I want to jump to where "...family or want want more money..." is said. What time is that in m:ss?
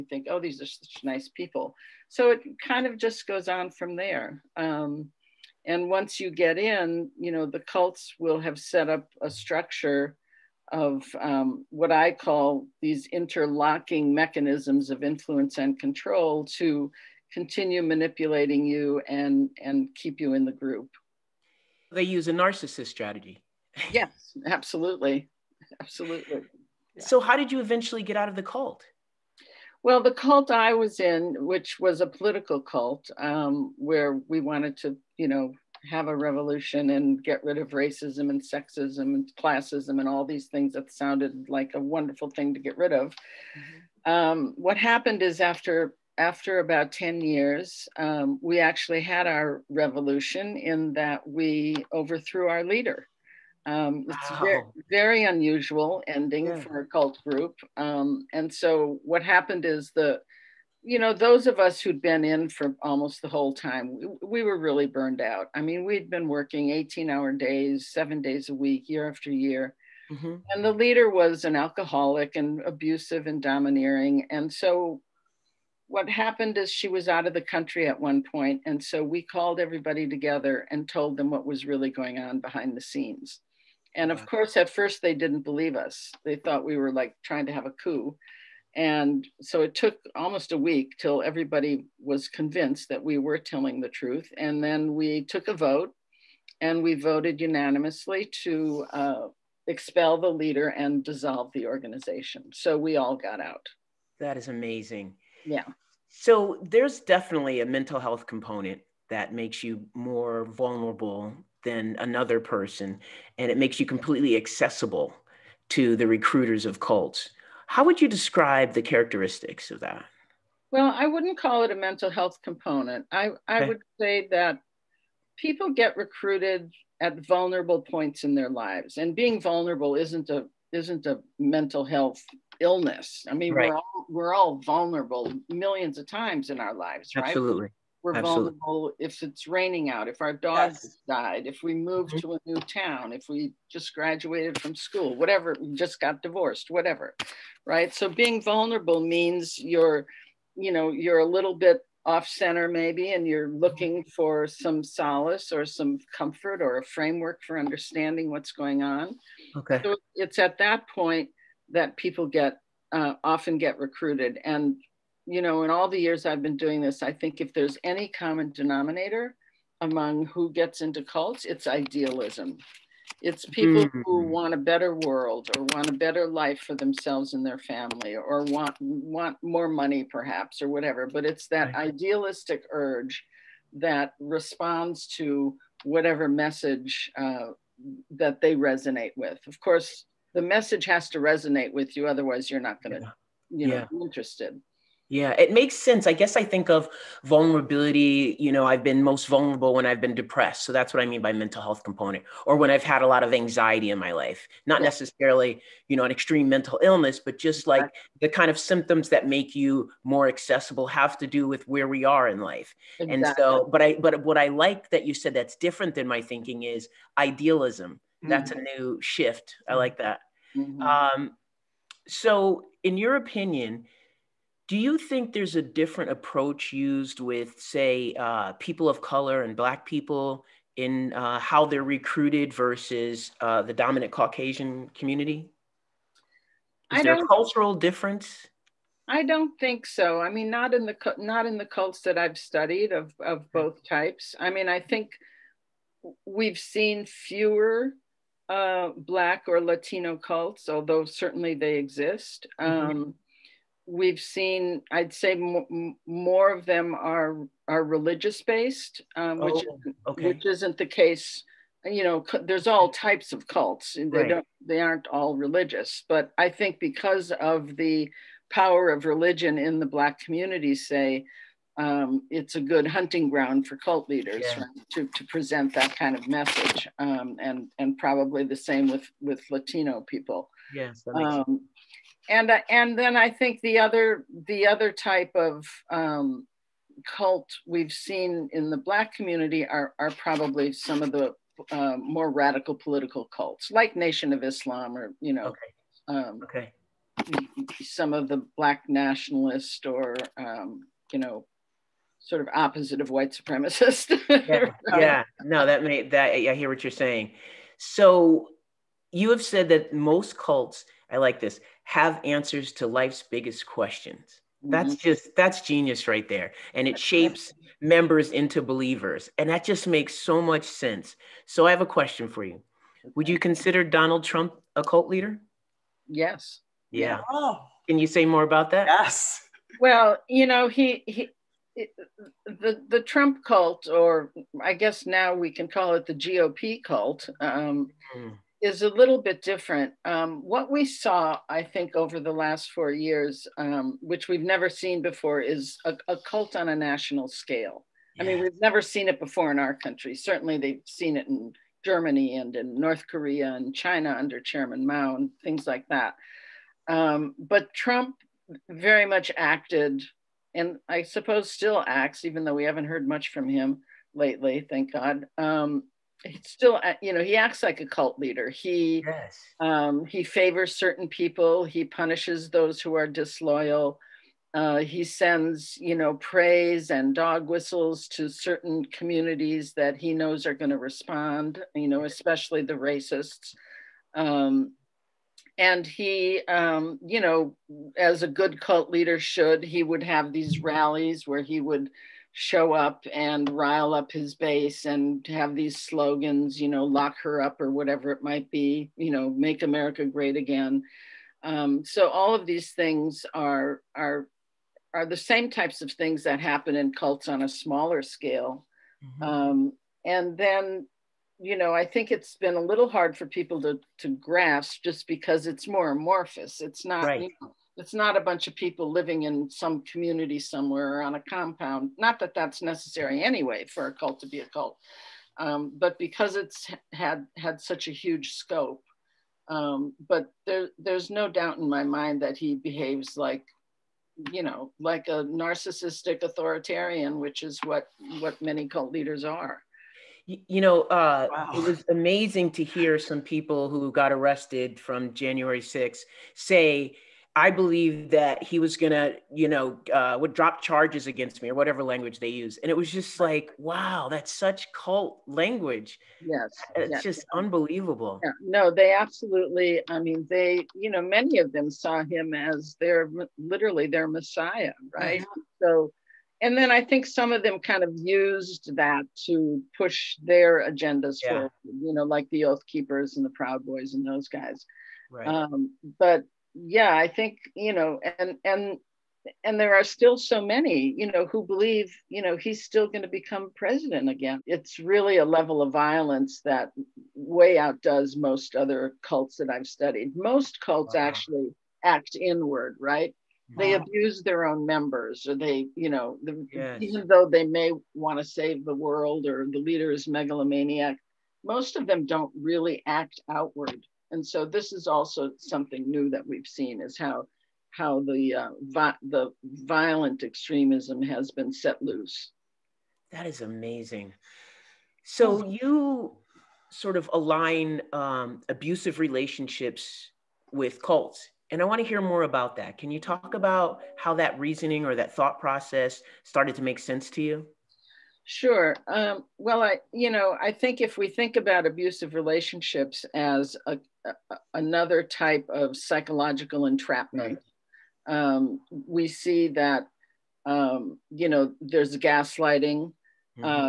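2:57.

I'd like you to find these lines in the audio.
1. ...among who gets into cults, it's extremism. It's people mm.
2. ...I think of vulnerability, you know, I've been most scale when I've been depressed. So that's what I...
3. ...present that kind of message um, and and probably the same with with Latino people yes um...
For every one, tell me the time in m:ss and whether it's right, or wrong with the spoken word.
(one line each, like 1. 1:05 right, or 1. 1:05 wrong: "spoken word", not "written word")
1. 2:49 wrong: "idealism", not "extremism"
2. 3:16 wrong: "vulnerable", not "scale"
3. 4:35 right.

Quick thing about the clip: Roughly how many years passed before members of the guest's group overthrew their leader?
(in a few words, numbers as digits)
10.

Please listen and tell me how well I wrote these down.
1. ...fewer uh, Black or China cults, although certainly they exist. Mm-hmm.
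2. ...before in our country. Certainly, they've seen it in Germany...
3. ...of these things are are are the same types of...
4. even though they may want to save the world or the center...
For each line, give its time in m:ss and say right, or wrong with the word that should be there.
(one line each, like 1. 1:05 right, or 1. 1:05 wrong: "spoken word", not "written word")
1. 4:07 wrong: "Latino", not "China"
2. 5:49 right
3. 6:42 right
4. 8:16 wrong: "leader", not "center".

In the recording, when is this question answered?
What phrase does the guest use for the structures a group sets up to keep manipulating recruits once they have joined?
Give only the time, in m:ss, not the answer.
0:13.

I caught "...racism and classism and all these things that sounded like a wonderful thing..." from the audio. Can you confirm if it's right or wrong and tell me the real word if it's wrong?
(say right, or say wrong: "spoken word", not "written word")
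wrong: "sexism", not "racism".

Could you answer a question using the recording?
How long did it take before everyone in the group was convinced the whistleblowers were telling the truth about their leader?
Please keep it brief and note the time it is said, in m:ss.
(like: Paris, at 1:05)
almost a week, at 1:30.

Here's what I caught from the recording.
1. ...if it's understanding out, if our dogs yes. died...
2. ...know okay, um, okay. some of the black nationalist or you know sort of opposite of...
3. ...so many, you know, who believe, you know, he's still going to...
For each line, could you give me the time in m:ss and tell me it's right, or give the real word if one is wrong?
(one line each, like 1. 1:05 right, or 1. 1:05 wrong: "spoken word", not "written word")
1. 2:18 wrong: "raining", not "understanding"
2. 4:55 right
3. 8:00 right.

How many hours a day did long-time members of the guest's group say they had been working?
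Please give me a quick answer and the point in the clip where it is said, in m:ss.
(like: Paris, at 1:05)
18, at 1:06.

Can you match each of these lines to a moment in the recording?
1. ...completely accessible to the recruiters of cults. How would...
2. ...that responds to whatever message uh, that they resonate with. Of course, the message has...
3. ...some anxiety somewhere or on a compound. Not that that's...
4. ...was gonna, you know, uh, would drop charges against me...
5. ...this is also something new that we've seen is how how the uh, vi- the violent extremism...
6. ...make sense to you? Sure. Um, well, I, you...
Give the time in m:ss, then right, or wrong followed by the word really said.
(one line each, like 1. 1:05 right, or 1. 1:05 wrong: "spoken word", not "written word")
1. 1:53 right
2. 3:03 right
3. 6:59 wrong: "community", not "anxiety"
4. 7:28 right
5. 8:24 right
6. 8:46 right.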